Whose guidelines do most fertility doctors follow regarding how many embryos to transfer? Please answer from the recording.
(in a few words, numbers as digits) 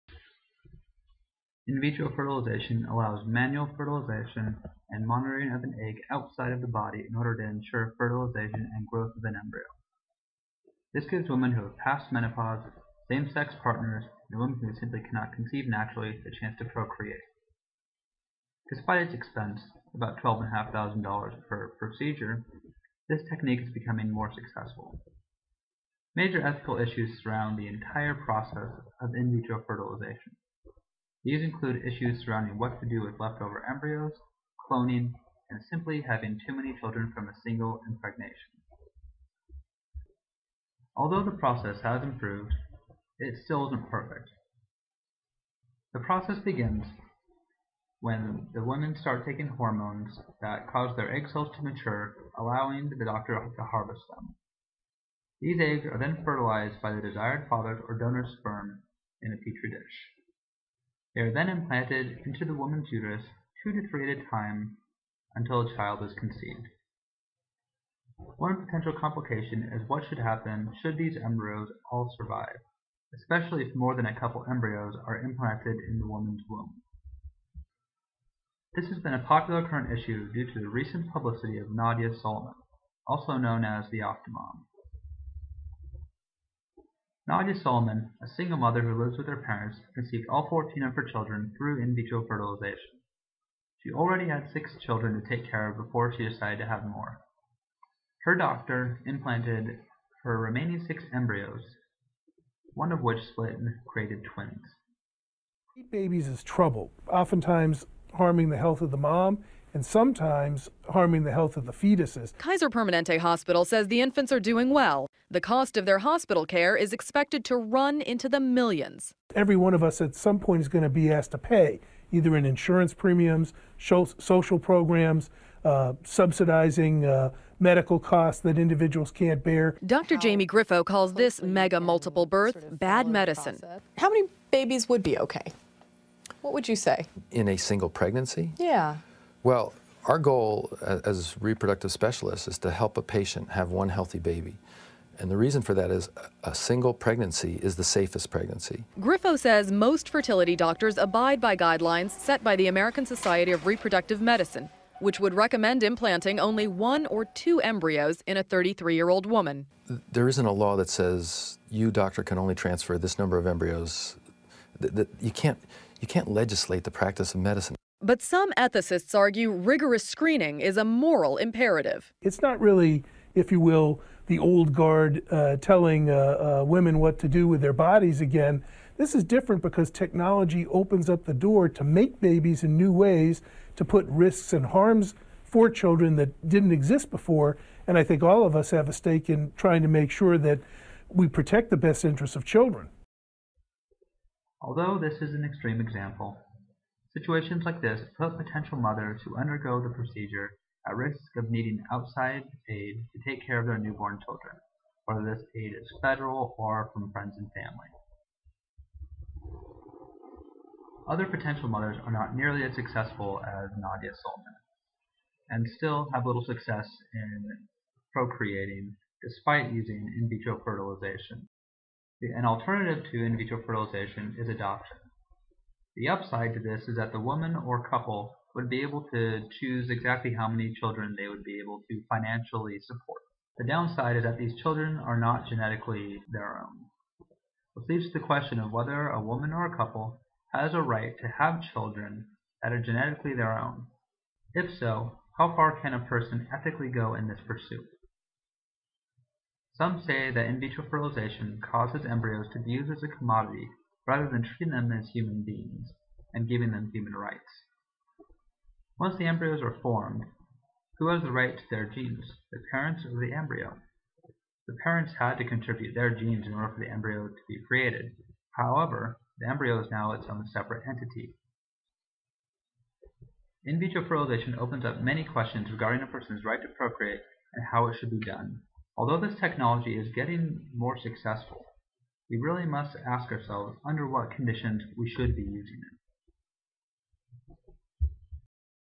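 American Society of Reproductive Medicine.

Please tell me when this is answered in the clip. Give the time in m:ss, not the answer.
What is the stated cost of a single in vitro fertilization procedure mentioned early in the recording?
0:20.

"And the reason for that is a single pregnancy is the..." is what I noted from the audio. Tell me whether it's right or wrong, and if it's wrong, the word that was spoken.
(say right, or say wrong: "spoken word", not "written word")
right.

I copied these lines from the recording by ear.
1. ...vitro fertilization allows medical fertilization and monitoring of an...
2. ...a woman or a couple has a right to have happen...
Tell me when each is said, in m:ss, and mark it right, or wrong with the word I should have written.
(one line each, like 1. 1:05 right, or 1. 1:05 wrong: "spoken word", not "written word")
1. 0:01 wrong: "manual", not "medical"
2. 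3:59 wrong: "children", not "happen".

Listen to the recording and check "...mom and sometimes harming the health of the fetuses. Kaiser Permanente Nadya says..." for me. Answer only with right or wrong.
wrong.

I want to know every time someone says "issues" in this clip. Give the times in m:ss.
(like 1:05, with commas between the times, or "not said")
0:26, 0:31, 1:19.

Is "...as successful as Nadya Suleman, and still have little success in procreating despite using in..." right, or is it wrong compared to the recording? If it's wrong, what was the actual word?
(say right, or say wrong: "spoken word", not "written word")
right.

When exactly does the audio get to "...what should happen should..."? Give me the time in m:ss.
1:09.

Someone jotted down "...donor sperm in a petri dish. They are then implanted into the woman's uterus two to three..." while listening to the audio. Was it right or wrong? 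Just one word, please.
right.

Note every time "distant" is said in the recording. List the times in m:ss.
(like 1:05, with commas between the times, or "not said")
not said.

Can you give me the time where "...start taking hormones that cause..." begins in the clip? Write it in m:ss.
0:48.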